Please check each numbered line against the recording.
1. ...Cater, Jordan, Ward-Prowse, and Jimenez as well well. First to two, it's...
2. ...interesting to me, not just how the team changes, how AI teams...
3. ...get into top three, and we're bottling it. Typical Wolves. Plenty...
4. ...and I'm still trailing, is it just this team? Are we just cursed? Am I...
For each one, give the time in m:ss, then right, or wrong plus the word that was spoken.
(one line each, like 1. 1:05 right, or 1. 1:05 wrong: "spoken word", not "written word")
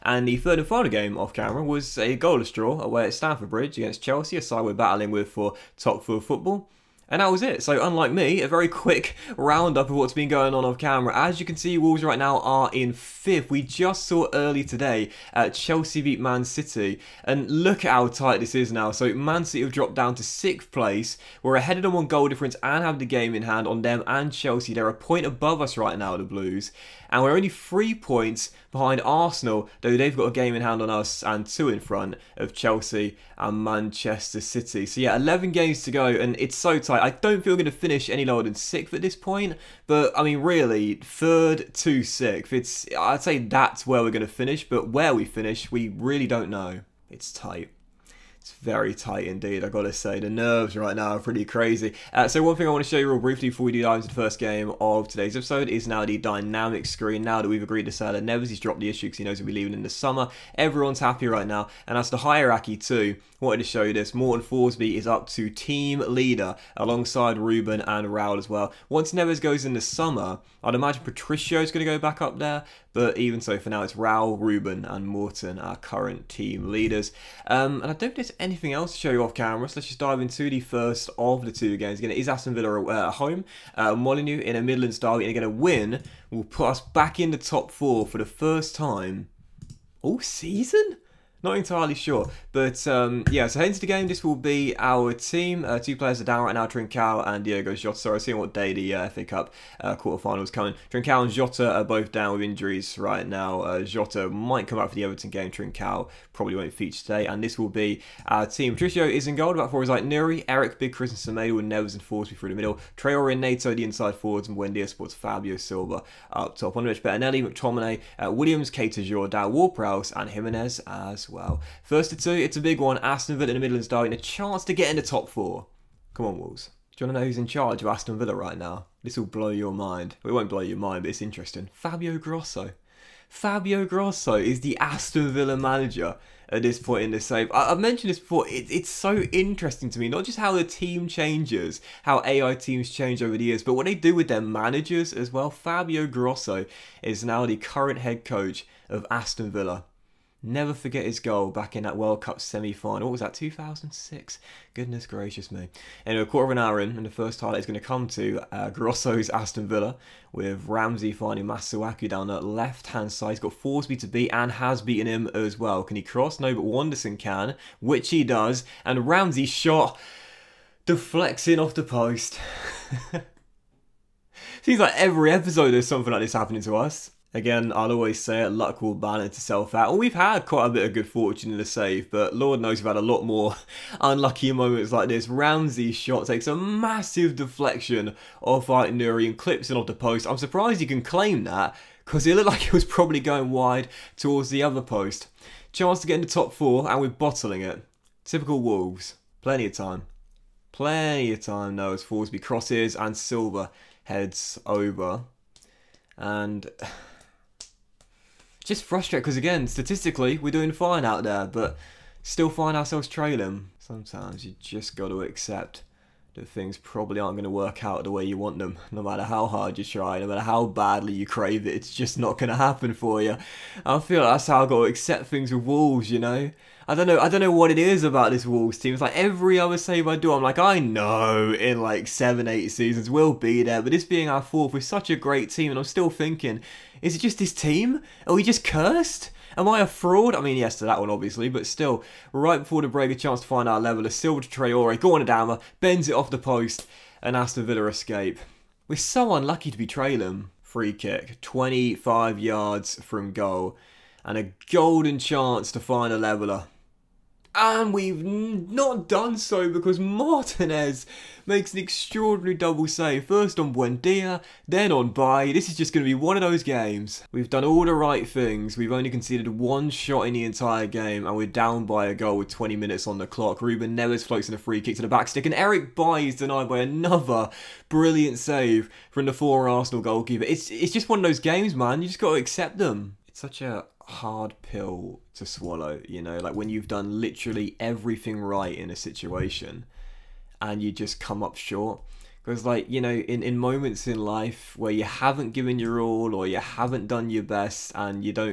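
1. 1:58 right
2. 2:19 right
3. 3:16 wrong: "four", not "three"
4. 3:55 wrong: "thinking", not "trailing".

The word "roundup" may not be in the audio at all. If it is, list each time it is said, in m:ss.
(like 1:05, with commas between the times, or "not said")
0:09.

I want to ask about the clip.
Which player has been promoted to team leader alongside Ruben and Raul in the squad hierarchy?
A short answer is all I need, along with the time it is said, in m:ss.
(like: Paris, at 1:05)
Morten Thorsby, at 1:04.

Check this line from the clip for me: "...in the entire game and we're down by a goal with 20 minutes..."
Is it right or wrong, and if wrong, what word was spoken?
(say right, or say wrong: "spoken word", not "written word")
right.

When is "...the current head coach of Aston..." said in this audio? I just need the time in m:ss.
2:27.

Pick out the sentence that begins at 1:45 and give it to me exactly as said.
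Trincao probably won't feature today, and this will be our team.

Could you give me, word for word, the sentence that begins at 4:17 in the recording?
And we've not done so because Martinez makes an extraordinary double save.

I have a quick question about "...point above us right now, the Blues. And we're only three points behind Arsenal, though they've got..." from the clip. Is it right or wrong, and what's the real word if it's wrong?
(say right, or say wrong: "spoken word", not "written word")
right.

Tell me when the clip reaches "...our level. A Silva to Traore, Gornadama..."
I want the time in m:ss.
4:03.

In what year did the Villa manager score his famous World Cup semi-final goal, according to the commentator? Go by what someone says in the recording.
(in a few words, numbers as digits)
2006.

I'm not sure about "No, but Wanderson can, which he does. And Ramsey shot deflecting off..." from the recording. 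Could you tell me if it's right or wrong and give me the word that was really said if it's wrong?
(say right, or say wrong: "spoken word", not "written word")
right.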